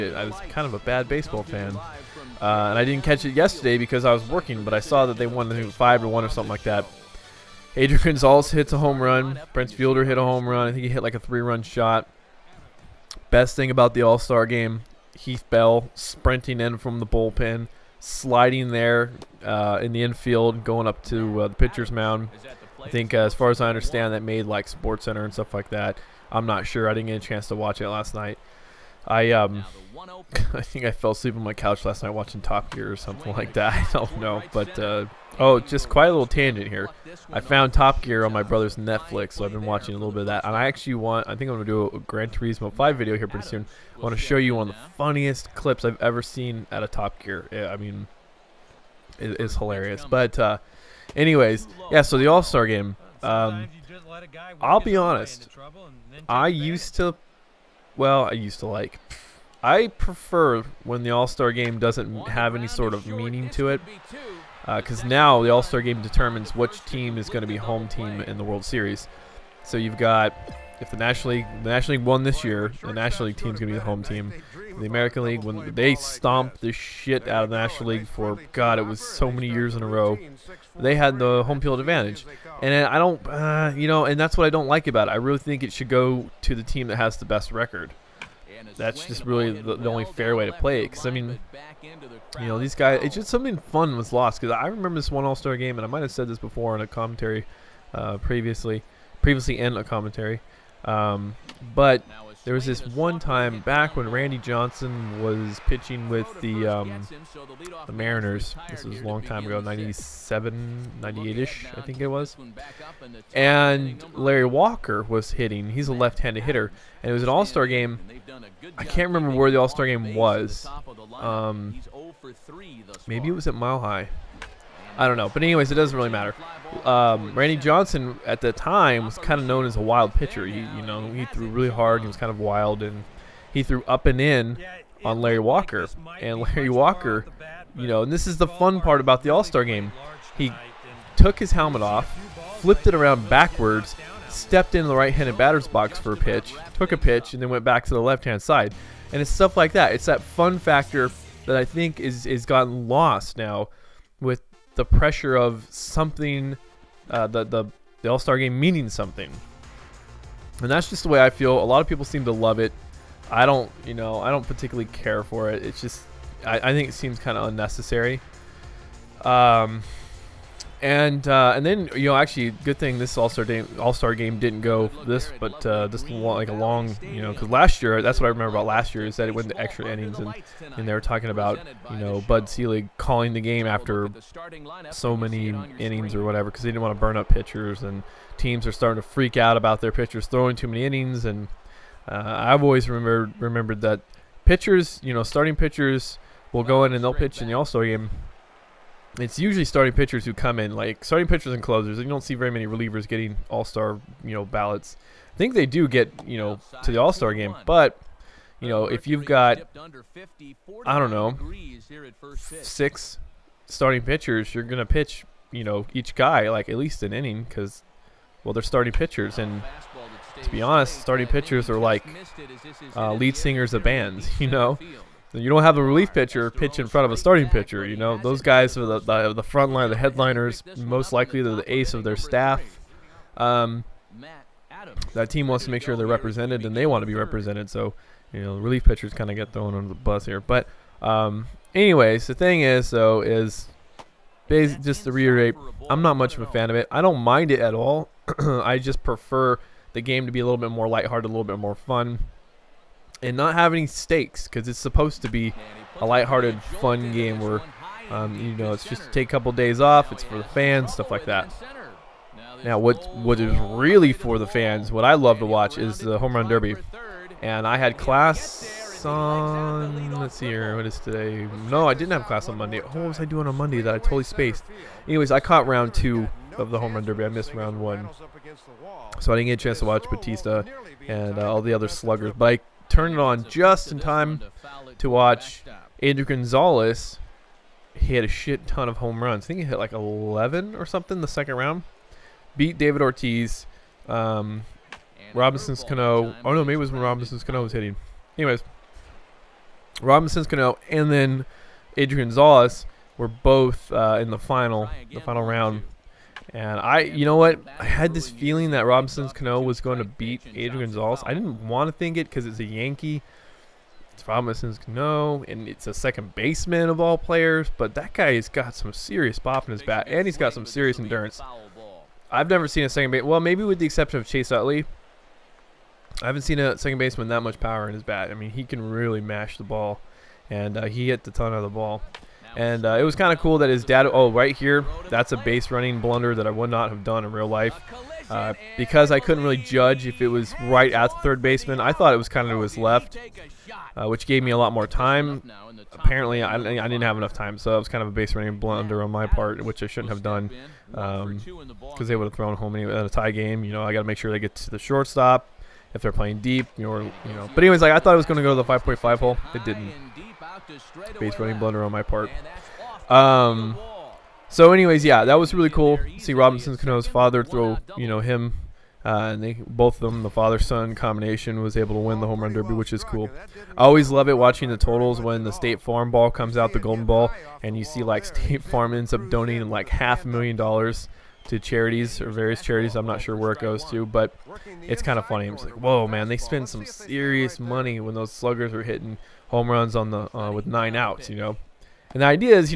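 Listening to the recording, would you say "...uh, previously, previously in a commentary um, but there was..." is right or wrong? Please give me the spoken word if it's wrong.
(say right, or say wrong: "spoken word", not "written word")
right.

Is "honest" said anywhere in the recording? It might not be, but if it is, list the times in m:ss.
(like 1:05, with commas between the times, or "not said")
0:54, 3:40.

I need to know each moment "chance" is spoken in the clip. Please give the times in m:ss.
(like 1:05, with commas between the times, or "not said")
0:27, 4:39.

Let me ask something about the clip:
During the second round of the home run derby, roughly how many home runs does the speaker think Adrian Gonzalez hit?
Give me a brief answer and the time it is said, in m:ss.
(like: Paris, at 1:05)
11, at 4:49.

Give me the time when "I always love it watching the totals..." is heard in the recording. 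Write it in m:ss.
6:13.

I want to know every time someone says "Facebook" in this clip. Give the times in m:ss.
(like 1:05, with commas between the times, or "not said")
not said.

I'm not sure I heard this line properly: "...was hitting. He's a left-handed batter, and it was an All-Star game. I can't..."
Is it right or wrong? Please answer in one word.
wrong.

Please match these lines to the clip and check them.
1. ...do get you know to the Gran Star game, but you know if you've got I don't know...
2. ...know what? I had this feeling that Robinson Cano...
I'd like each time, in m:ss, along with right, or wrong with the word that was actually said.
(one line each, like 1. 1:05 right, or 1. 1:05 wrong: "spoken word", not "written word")
1. 3:25 wrong: "All", not "Gran"
2. 5:07 right.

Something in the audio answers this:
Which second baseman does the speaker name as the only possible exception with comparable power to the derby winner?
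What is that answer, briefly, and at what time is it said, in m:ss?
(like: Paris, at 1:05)
Chase Utley, at 5:24.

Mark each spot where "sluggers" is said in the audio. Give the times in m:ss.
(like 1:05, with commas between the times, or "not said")
4:41, 6:28.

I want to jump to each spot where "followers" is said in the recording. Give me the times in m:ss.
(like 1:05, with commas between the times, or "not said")
not said.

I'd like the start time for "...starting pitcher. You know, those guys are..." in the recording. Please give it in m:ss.
3:47.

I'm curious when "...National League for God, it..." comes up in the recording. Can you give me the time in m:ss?
1:17.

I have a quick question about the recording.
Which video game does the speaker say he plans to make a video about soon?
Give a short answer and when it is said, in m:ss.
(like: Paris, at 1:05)
Gran Turismo 5, at 0:41.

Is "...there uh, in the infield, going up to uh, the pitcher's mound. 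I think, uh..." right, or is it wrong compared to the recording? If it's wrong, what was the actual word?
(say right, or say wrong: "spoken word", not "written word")
right.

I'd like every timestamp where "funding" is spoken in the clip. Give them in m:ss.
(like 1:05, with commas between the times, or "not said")
not said.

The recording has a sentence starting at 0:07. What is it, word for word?
Adrian Gonzalez hits a home run.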